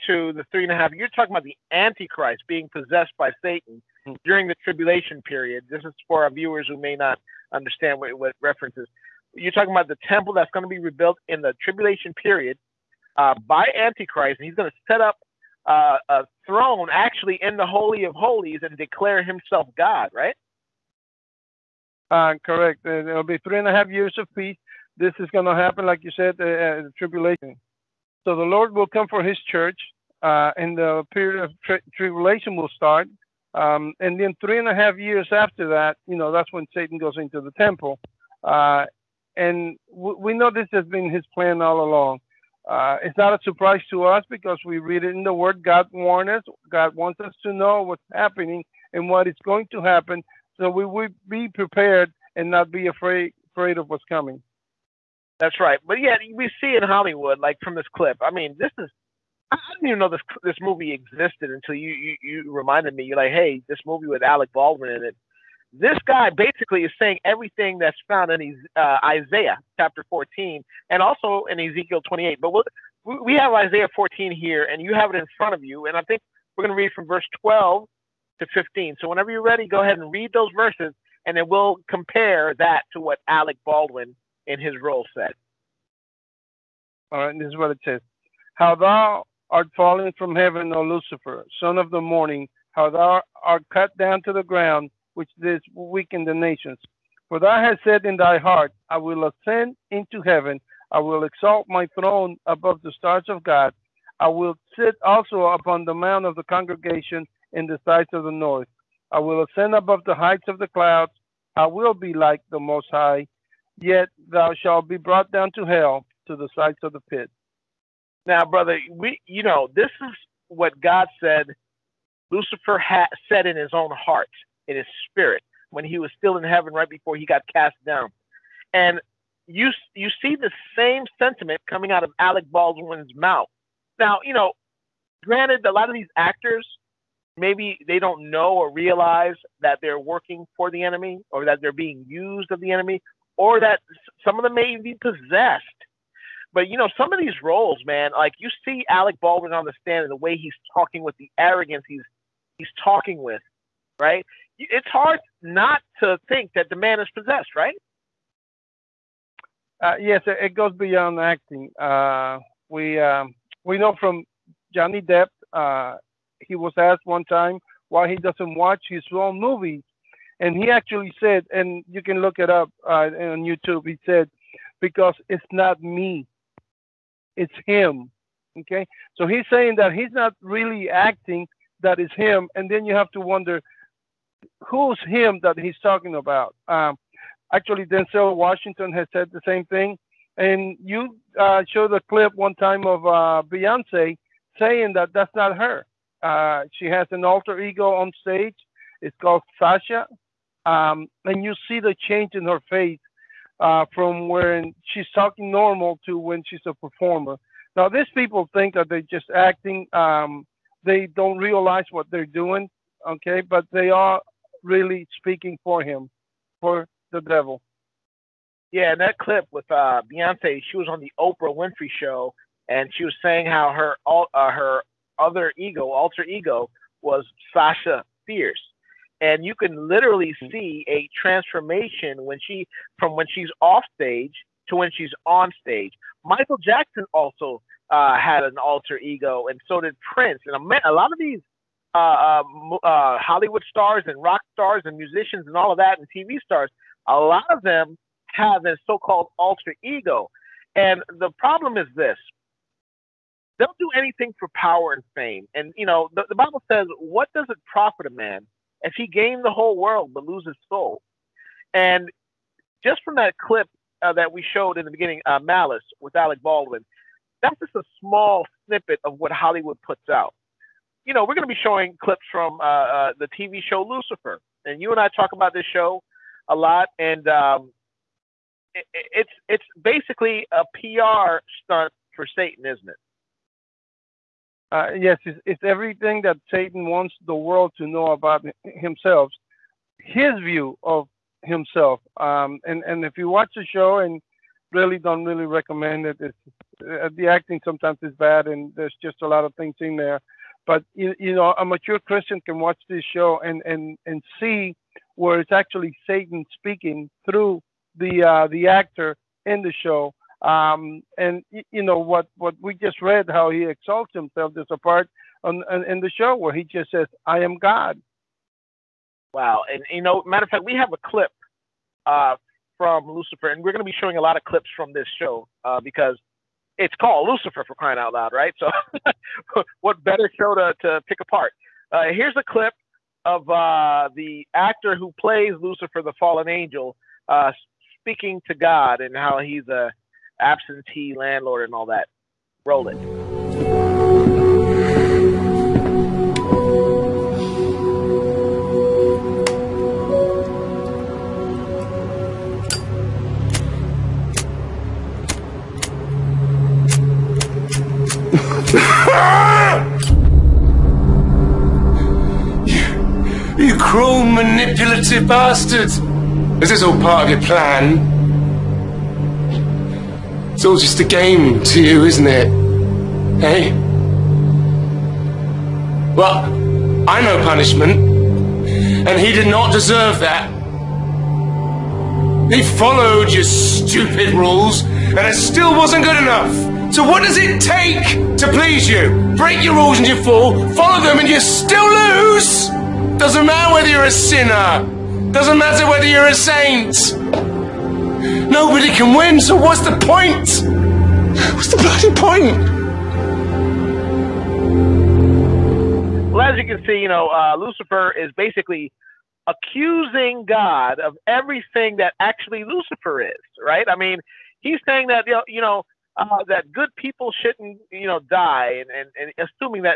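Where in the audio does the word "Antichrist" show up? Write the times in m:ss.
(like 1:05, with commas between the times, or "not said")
0:01, 0:13.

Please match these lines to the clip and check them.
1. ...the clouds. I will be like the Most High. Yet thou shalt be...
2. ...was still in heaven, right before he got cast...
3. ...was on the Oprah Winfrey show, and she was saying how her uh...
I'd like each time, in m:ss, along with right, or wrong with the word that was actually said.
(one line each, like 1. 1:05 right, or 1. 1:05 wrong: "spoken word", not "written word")
1. 1:50 right
2. 2:05 right
3. 3:40 right.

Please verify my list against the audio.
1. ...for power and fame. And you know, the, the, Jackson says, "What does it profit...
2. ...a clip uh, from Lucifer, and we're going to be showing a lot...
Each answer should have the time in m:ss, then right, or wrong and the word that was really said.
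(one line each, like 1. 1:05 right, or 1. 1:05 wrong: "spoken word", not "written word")
1. 4:14 wrong: "Bible", not "Jackson"
2. 5:20 right.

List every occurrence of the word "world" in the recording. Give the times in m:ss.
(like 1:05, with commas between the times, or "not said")
4:19, 4:47.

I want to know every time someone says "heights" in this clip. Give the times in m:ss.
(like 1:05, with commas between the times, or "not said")
1:50.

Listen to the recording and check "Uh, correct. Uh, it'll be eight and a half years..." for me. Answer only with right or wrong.
wrong.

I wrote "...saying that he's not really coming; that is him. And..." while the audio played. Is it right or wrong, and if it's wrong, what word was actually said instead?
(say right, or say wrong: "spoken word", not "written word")
wrong: "acting", not "coming".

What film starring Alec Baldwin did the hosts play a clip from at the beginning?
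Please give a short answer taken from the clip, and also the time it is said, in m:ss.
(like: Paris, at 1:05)
Malice, at 4:25.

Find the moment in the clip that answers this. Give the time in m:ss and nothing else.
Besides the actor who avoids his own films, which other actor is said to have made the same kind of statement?
3:07.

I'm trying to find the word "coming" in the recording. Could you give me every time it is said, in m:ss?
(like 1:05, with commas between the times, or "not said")
0:54, 2:11.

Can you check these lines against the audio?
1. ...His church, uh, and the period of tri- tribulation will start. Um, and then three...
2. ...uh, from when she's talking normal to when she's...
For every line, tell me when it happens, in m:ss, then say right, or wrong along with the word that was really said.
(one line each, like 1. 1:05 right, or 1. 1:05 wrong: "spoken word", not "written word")
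1. 0:29 right
2. 3:23 right.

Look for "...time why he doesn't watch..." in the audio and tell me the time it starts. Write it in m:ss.
2:47.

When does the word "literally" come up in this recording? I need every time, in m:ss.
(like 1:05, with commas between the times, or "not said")
3:49.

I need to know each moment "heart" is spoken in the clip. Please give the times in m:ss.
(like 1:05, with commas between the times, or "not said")
1:38, 2:03.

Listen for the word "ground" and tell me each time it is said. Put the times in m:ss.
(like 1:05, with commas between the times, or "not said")
1:34.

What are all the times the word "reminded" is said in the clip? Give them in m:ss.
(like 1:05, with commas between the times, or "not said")
1:02.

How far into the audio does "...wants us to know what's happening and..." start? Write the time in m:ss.
0:46.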